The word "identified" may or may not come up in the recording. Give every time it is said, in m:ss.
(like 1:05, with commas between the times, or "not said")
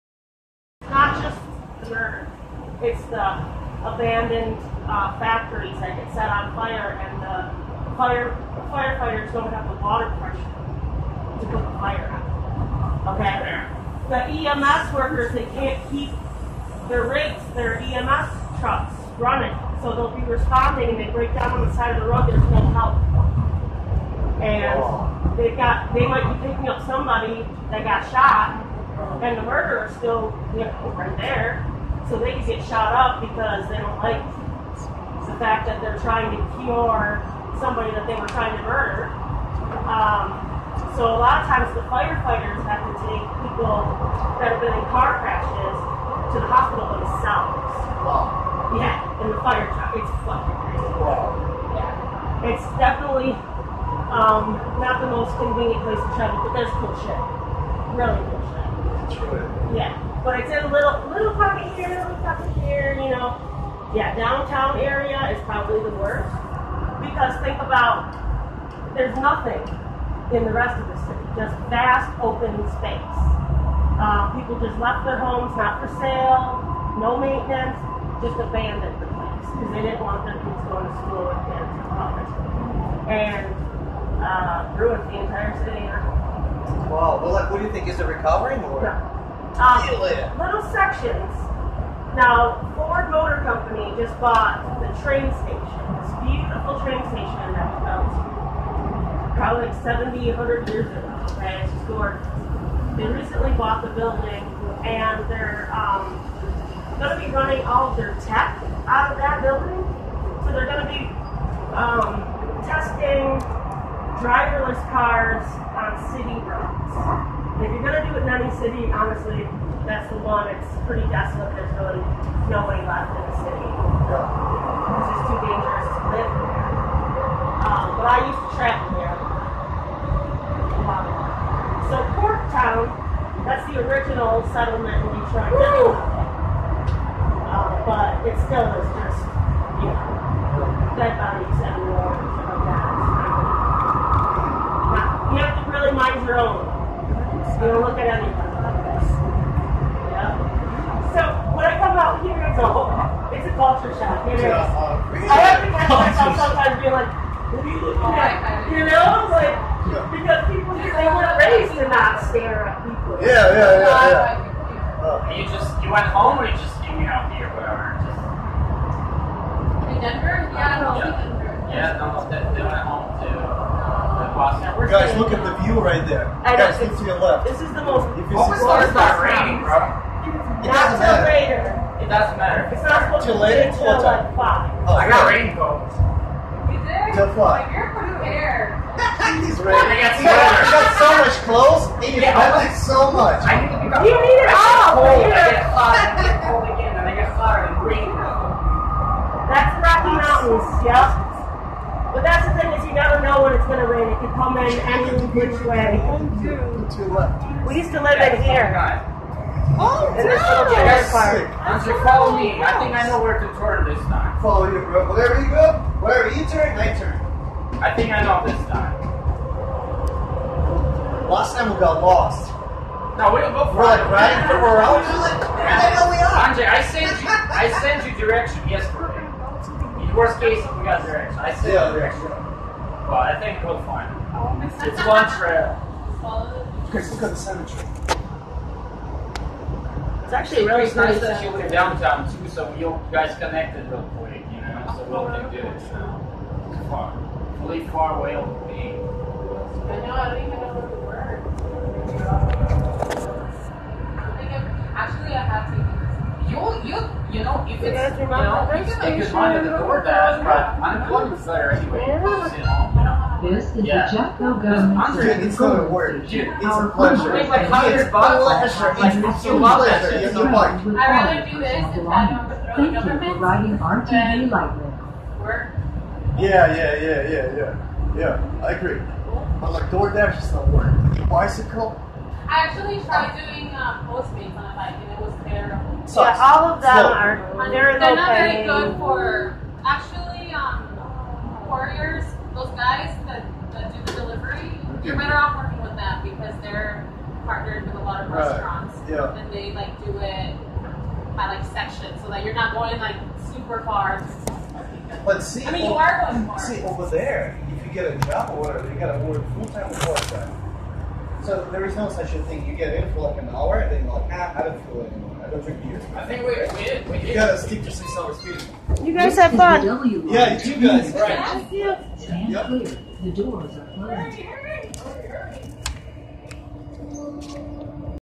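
not said.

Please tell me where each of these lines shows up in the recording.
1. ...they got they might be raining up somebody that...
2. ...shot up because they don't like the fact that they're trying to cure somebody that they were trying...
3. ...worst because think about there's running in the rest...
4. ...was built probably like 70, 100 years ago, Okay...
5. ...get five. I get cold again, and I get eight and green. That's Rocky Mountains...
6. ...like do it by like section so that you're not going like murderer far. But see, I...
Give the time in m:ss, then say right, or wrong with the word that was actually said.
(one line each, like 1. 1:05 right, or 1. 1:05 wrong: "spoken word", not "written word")
1. 0:25 wrong: "picking", not "raining"
2. 0:32 right
3. 1:05 wrong: "nothing", not "running"
4. 1:37 right
5. 3:15 wrong: "five", not "eight"
6. 4:59 wrong: "super", not "murderer".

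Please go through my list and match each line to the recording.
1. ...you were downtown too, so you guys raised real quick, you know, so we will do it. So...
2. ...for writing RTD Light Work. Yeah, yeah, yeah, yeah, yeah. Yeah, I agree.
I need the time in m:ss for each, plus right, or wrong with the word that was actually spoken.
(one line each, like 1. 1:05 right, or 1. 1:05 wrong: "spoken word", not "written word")
1. 4:01 wrong: "connected", not "raised"
2. 4:33 right.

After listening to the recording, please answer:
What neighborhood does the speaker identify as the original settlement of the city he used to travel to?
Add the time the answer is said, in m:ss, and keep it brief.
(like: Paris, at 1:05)
Corktown, at 2:12.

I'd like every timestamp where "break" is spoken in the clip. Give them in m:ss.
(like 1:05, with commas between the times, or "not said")
0:21.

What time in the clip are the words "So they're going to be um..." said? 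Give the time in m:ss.
1:50.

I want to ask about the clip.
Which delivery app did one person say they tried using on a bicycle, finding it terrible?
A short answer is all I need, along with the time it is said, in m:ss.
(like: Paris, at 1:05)
Postmates, at 4:44.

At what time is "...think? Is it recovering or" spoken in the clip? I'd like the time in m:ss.
1:27.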